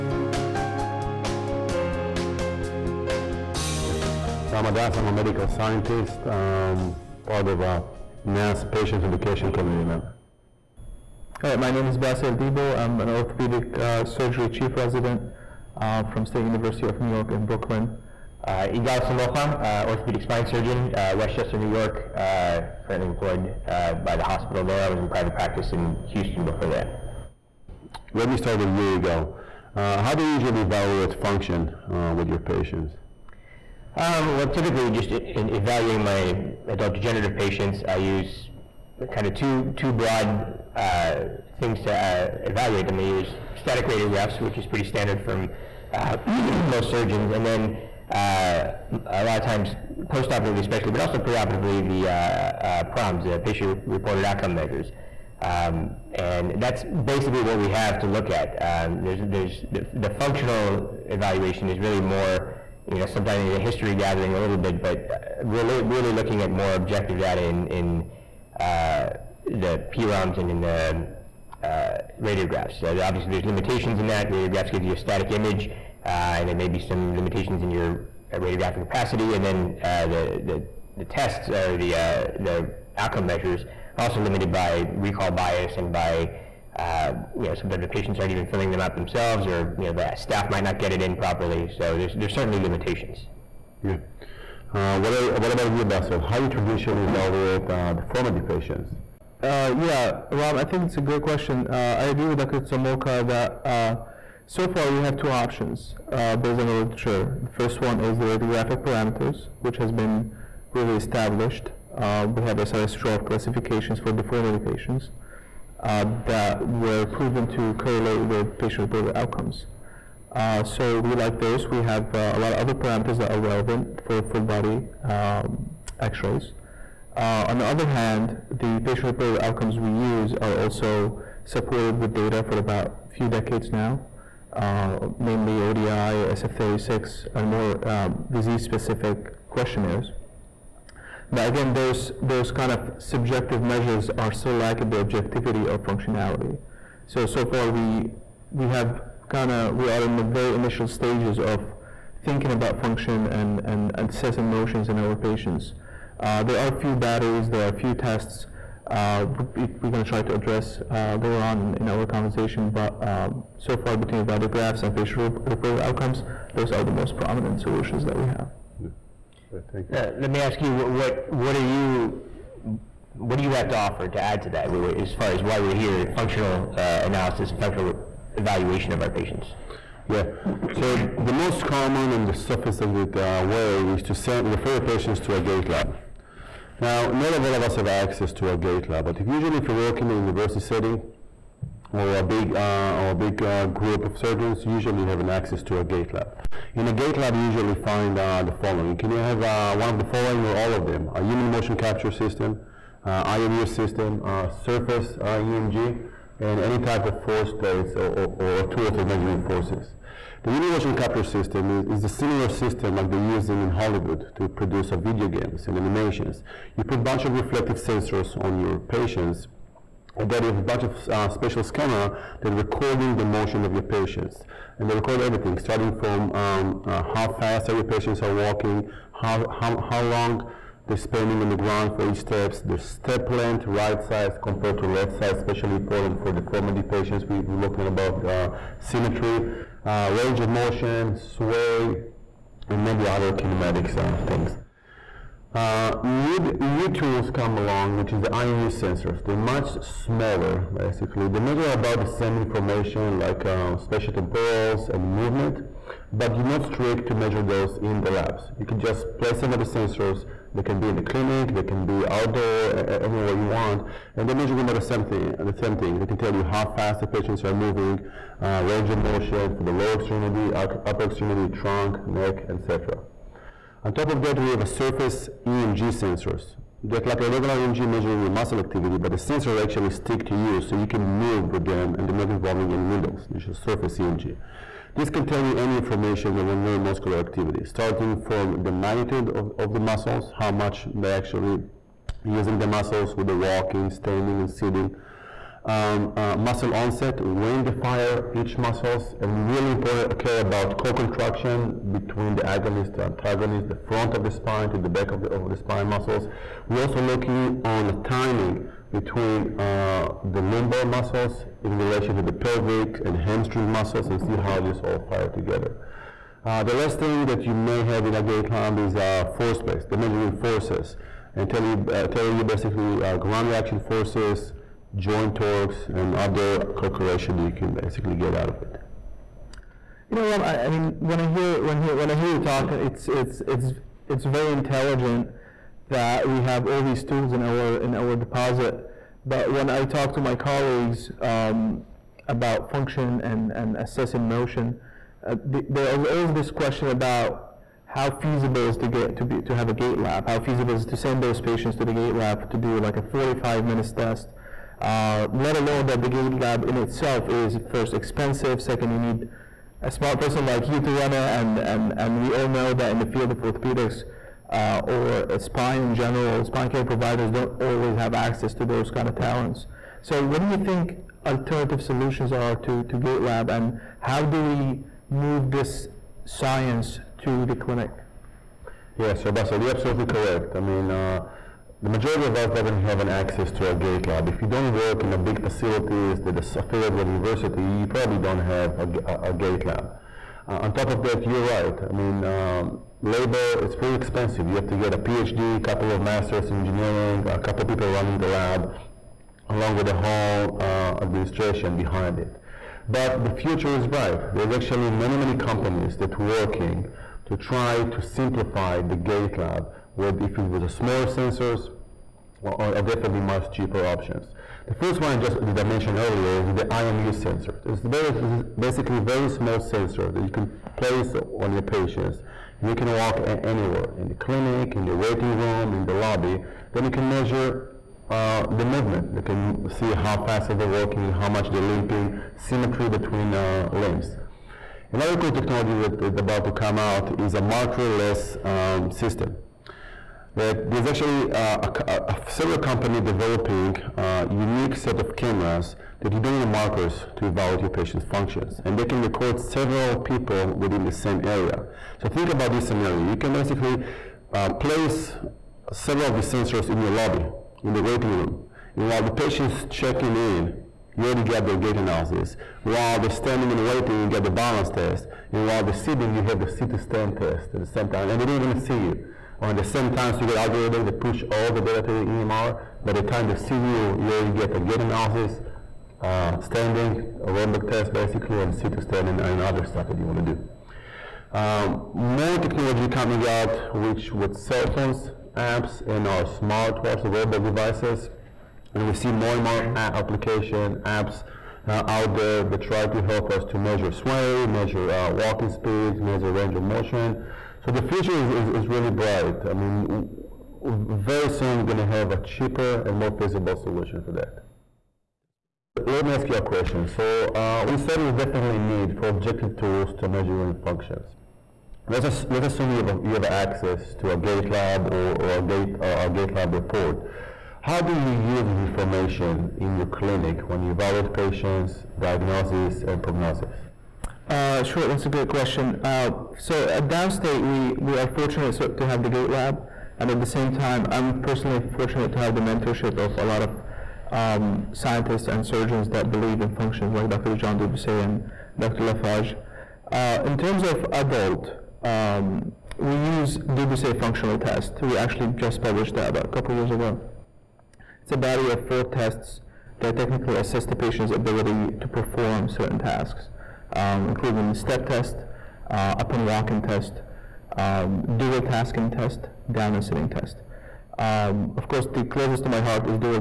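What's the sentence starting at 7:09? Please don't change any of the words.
You can see how fast they're walking, how much they're limping, symmetry between uh, limbs.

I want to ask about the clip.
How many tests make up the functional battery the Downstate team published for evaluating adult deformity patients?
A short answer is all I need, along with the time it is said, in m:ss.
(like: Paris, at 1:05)
4, at 9:08.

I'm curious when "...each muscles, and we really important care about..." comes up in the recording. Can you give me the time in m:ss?
4:58.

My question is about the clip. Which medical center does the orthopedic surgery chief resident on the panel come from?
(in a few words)
State University of New York in Brooklyn.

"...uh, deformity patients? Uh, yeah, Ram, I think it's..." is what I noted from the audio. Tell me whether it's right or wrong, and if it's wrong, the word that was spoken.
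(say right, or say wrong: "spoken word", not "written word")
right.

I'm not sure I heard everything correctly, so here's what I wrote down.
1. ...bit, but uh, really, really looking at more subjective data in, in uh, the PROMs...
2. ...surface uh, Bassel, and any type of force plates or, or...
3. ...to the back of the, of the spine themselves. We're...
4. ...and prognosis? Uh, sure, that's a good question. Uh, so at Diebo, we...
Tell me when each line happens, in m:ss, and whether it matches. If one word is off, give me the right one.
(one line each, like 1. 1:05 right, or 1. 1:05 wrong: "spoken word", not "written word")
1. 1:04 wrong: "objective", not "subjective"
2. 3:24 wrong: "EMG", not "Bassel"
3. 5:04 wrong: "muscles", not "themselves"
4. 8:42 wrong: "Downstate", not "Diebo".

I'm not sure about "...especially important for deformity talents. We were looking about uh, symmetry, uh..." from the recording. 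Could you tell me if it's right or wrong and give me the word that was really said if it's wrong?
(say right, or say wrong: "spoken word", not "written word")
wrong: "patients", not "talents".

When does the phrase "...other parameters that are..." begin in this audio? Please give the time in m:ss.
2:02.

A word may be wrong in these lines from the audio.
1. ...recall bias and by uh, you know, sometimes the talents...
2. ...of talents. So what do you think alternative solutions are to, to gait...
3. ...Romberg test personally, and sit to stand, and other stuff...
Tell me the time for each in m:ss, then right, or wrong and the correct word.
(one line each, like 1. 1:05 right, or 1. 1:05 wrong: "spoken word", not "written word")
1. 1:24 wrong: "patients", not "talents"
2. 6:09 right
3. 7:57 wrong: "basically", not "personally".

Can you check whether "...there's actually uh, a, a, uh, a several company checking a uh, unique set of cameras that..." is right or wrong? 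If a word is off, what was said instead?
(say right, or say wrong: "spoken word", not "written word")
wrong: "developing", not "checking".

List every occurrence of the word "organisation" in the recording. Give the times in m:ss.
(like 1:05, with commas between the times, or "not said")
not said.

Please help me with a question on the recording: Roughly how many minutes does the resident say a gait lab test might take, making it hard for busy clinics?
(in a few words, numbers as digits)
45.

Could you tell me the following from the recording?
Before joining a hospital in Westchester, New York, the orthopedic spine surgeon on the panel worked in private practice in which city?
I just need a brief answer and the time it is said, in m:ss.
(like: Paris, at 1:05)
Houston, at 0:26.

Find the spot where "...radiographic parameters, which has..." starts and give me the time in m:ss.
1:48.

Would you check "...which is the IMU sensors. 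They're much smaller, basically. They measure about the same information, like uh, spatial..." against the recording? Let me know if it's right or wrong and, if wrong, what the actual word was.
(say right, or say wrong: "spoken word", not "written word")
right.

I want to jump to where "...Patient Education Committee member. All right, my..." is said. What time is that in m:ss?
0:08.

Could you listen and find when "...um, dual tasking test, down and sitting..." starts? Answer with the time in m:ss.
9:17.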